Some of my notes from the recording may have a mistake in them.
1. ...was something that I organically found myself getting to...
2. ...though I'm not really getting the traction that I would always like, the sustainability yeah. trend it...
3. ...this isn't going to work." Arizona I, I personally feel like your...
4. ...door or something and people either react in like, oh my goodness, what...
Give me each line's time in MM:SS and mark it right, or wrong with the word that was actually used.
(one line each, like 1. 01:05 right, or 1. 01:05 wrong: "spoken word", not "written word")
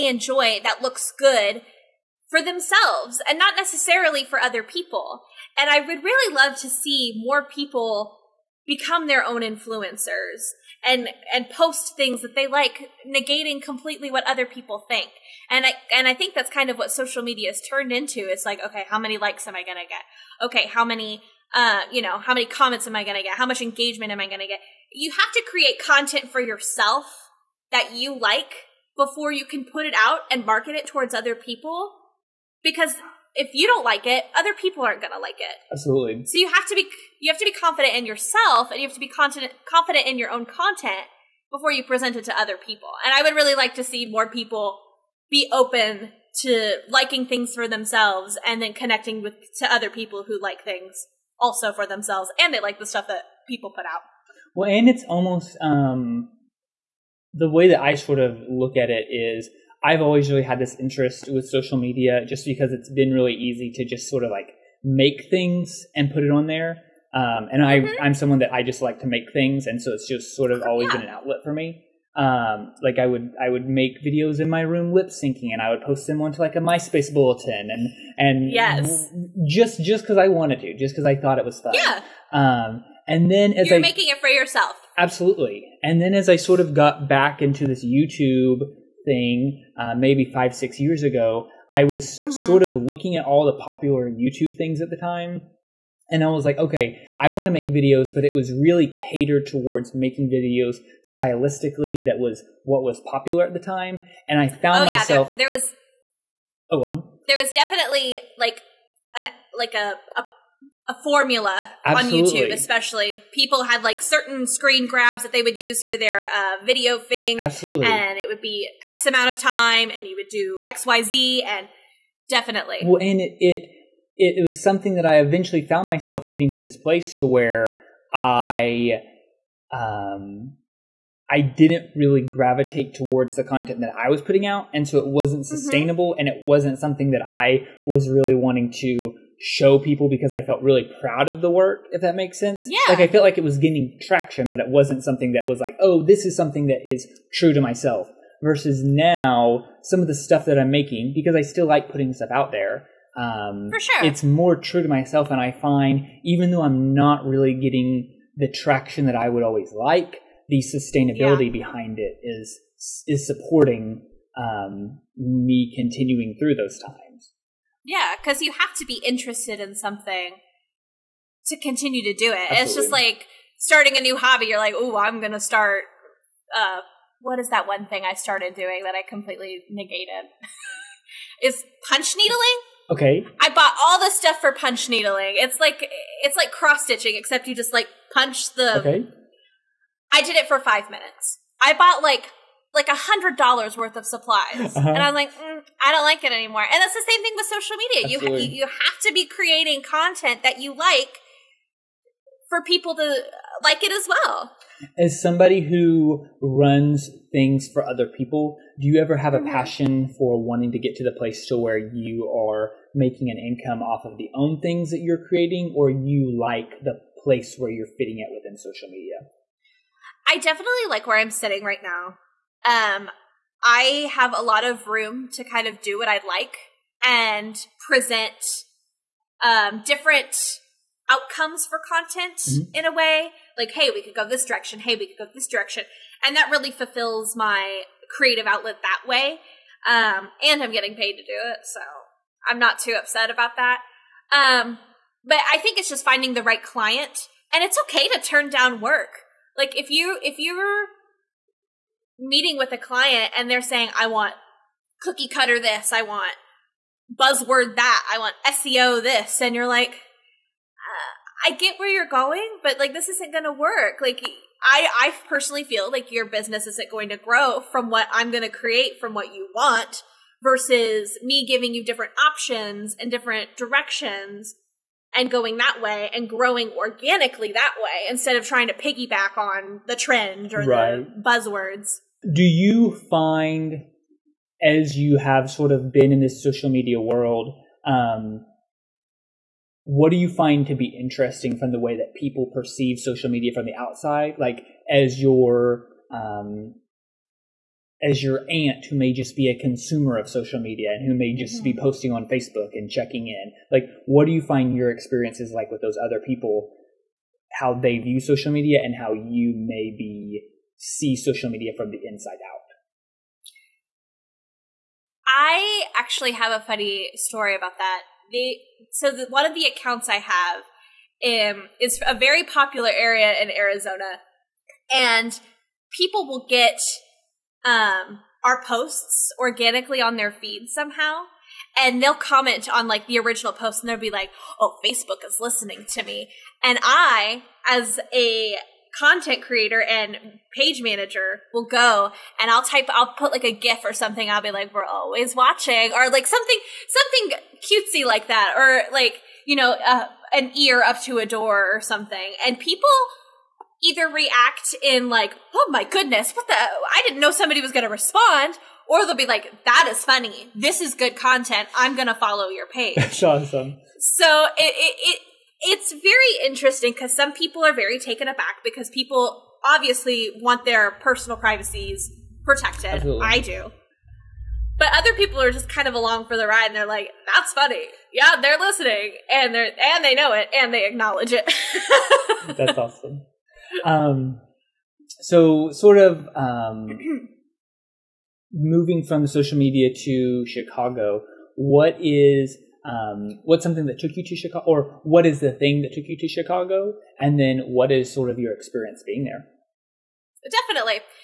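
1. 02:04 wrong: "eventually", not "organically"
2. 02:36 wrong: "behind", not "trend"
3. 04:22 wrong: "Like", not "Arizona"
4. 05:51 right.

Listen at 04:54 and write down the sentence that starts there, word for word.
Like, as your um, as your aunt who may just be a consumer of social media and who may just mm-hmm.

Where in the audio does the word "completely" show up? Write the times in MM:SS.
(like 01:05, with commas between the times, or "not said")
00:13, 02:59.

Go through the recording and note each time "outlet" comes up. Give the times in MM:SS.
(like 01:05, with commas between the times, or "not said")
01:11, 03:58.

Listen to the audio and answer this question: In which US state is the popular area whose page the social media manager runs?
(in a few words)
Arizona.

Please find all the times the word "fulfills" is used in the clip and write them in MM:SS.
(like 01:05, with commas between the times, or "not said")
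03:56.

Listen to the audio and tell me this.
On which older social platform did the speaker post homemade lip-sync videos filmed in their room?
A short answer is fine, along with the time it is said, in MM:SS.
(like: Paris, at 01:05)
MySpace, at 01:16.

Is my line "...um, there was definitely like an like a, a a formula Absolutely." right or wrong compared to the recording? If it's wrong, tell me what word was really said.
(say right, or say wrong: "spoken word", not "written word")
right.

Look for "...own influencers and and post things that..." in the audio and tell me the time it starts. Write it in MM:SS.
00:09.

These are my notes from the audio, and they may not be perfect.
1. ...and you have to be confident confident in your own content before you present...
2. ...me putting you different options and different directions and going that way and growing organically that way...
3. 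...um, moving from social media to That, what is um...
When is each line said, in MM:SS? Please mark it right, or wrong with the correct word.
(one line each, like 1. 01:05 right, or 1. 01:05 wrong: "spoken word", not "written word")
1. 00:38 right
2. 04:31 wrong: "giving", not "putting"
3. 06:26 wrong: "Chicago", not "That".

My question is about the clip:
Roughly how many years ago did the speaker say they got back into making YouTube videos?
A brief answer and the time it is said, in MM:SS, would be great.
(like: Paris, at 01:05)
5 or 6 years, at 01:30.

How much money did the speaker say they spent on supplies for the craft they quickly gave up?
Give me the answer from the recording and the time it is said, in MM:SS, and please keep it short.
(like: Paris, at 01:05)
$100, at 03:12.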